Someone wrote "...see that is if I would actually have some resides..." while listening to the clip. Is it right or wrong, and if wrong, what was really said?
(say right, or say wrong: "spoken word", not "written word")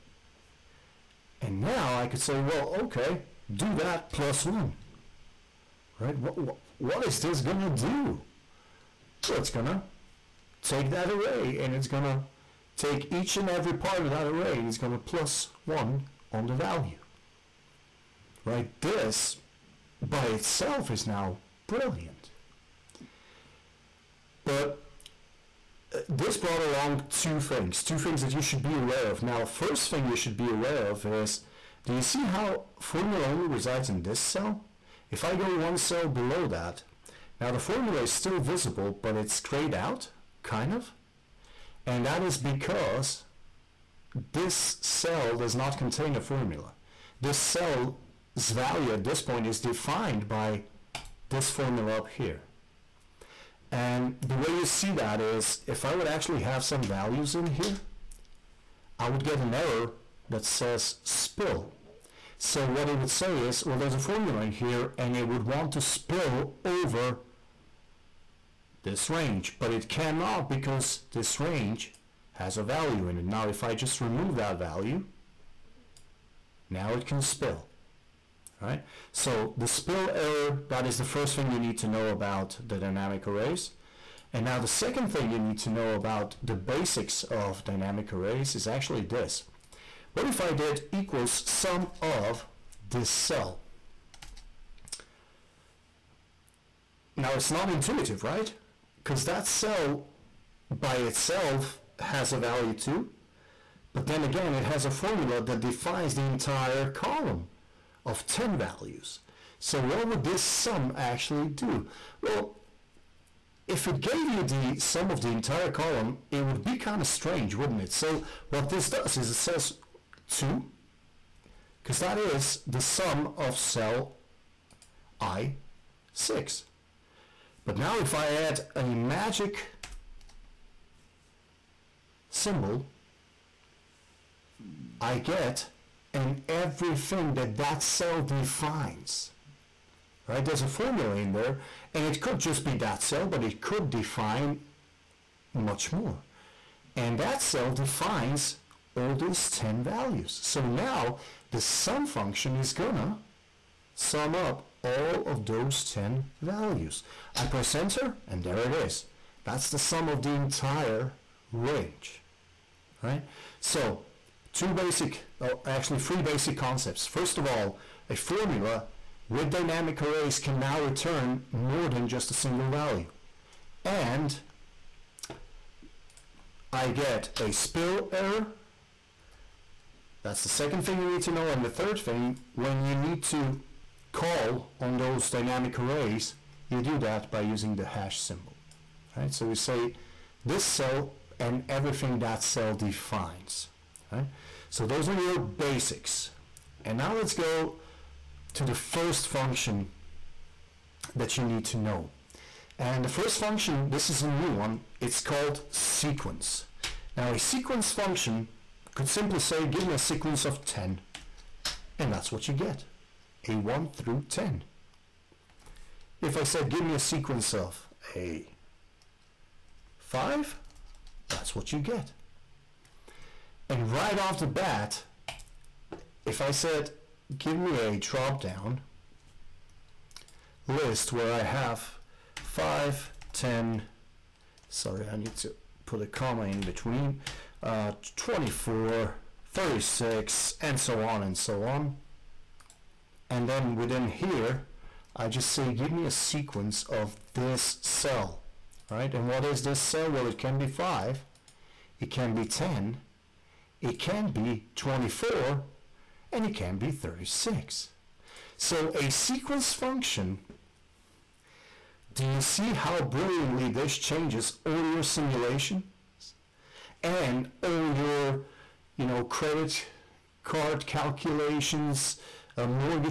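wrong: "values", not "resides".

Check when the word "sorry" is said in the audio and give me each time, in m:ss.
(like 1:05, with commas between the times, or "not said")
3:54.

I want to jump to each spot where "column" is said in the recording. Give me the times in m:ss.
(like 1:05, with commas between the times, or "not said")
1:46, 1:55.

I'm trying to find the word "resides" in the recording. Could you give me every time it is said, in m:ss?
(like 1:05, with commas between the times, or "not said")
0:33.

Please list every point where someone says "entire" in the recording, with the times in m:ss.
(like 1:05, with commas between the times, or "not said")
1:46, 1:55, 2:40.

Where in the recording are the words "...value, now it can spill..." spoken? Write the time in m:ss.
1:14.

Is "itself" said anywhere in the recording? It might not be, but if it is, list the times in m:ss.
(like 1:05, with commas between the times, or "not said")
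0:20, 1:40.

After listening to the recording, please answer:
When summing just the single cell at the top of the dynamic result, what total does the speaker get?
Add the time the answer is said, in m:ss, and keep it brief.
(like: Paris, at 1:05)
2, at 2:00.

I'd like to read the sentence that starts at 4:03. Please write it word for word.
And then within here, I just say, give me a sequence of this cell, right?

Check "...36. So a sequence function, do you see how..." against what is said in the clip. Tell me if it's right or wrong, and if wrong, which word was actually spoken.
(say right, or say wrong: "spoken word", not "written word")
right.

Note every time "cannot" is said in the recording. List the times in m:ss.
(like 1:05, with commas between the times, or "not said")
1:09.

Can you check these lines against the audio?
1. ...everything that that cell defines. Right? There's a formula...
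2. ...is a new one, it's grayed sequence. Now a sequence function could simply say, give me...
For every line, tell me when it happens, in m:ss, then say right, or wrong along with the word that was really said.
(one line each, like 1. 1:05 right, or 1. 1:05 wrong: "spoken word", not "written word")
1. 2:16 right
2. 3:24 wrong: "called", not "grayed".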